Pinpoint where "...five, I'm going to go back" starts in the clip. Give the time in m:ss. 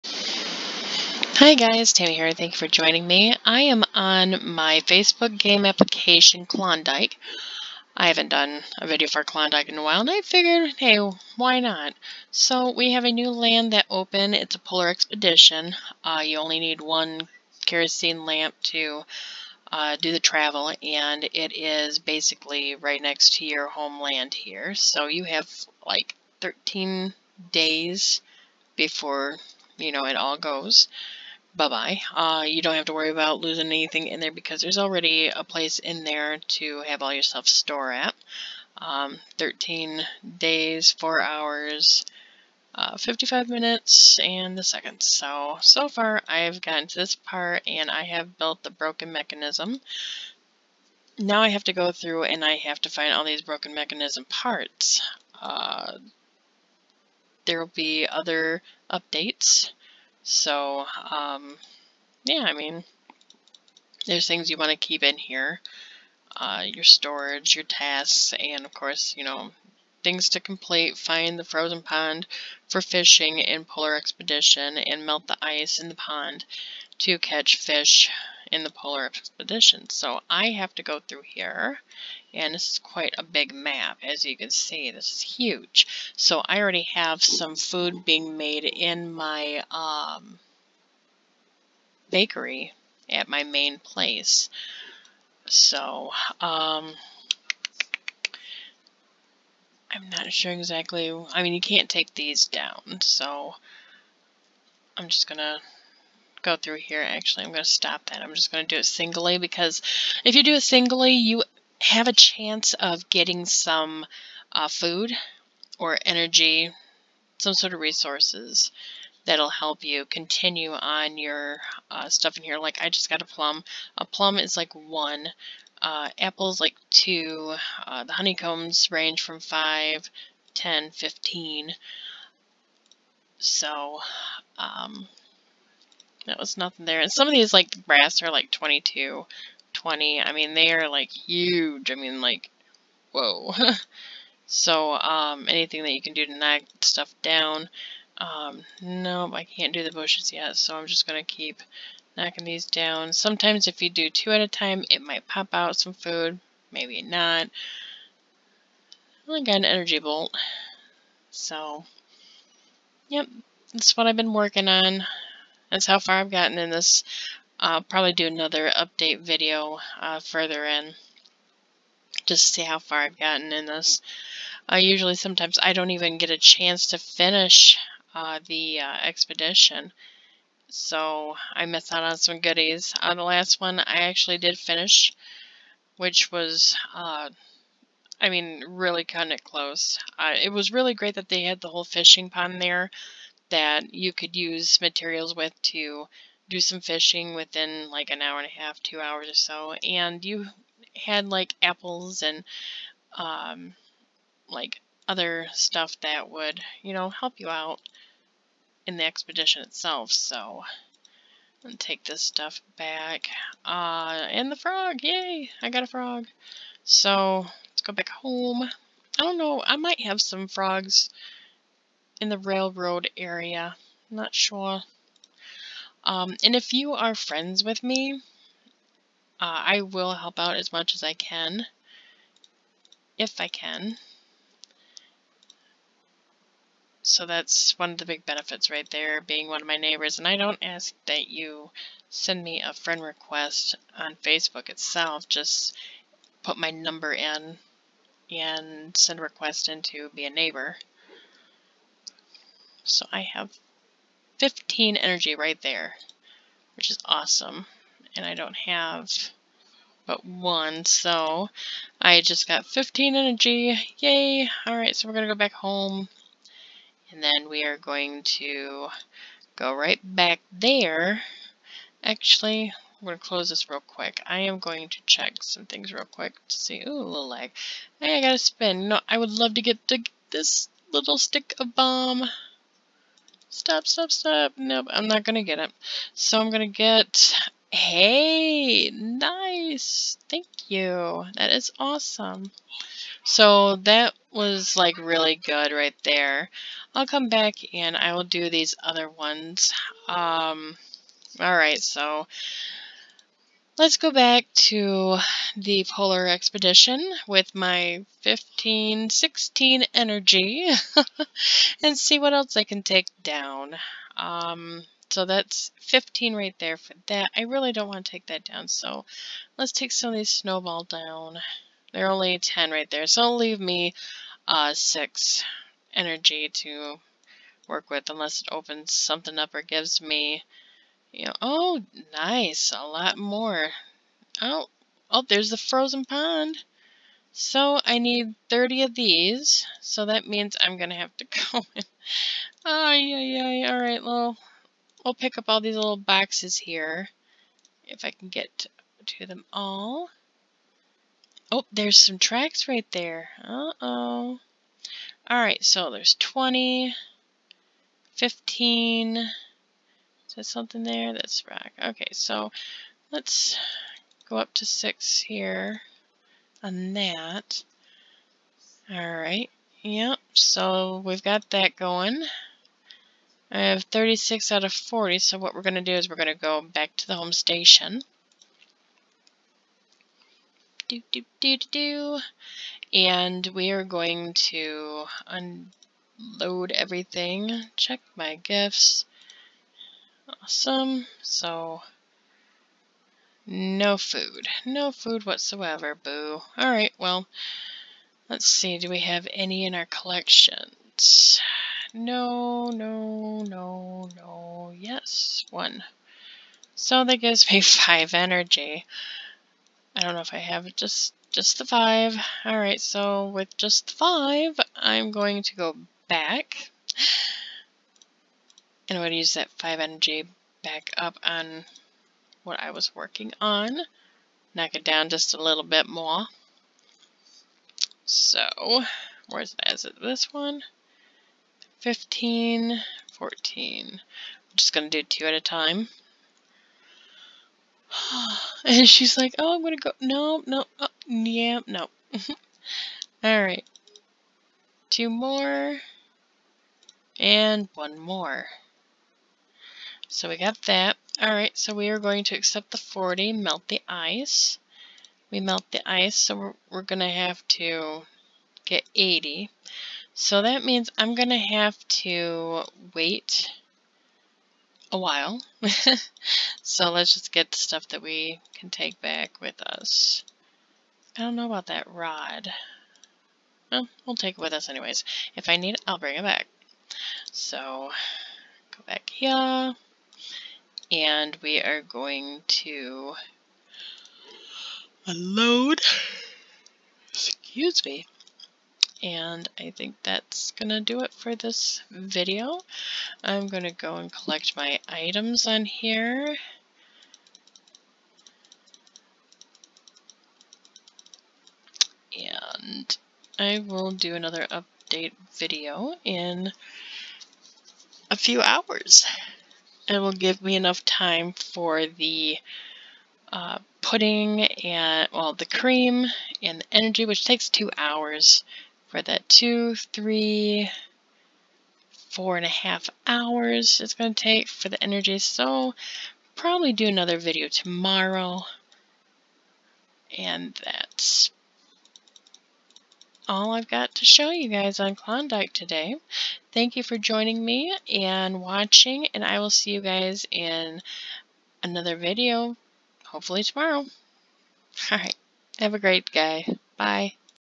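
6:53.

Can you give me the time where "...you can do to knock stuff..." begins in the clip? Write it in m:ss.
2:25.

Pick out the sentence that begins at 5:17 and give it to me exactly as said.
I really don't want to take that down, so let's take some of these snowball down.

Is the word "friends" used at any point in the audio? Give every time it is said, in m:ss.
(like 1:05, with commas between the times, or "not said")
3:47, 4:02.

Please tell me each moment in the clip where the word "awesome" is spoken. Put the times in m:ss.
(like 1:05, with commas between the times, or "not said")
4:17, 4:51, 6:30.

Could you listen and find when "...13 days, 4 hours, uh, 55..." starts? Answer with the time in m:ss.
0:39.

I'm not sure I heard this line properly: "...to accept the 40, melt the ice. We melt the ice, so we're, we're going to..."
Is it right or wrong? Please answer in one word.
right.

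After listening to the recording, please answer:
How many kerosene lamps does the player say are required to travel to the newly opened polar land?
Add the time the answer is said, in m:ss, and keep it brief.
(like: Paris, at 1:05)
1, at 0:16.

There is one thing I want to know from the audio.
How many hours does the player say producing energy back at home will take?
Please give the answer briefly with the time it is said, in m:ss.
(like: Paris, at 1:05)
4 and a half, at 8:42.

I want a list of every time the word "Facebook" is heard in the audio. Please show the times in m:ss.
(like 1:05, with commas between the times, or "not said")
0:04, 4:04.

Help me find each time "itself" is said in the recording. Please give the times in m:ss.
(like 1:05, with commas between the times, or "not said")
3:29, 4:04.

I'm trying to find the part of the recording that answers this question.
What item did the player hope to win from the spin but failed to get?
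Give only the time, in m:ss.
4:41.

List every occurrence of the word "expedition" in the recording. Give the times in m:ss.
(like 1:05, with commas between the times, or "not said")
0:14, 1:13, 1:19, 2:59, 3:29, 5:06.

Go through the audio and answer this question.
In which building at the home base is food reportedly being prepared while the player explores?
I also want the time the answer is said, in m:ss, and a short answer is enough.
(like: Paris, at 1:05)
bakery, at 1:32.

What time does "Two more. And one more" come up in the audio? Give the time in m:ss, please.
7:24.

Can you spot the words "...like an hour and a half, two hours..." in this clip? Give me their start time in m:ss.
3:17.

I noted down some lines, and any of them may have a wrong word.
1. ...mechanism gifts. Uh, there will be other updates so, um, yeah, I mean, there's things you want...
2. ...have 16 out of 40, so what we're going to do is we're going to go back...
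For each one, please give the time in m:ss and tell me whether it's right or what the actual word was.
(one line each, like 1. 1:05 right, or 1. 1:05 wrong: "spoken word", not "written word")
1. 0:53 wrong: "parts", not "gifts"
2. 6:13 wrong: "36", not "16".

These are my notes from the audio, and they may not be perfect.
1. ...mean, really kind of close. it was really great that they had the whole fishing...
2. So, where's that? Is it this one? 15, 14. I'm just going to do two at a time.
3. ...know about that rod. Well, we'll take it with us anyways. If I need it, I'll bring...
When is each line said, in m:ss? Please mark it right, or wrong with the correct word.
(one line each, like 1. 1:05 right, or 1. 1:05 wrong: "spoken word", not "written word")
1. 3:08 right
2. 7:08 right
3. 7:51 right.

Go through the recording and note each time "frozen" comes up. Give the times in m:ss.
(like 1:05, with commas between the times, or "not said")
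1:11, 5:35.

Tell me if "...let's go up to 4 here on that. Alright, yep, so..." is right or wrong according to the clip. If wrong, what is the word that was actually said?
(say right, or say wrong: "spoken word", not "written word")
wrong: "6", not "4".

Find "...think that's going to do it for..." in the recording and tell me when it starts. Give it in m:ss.
8:09.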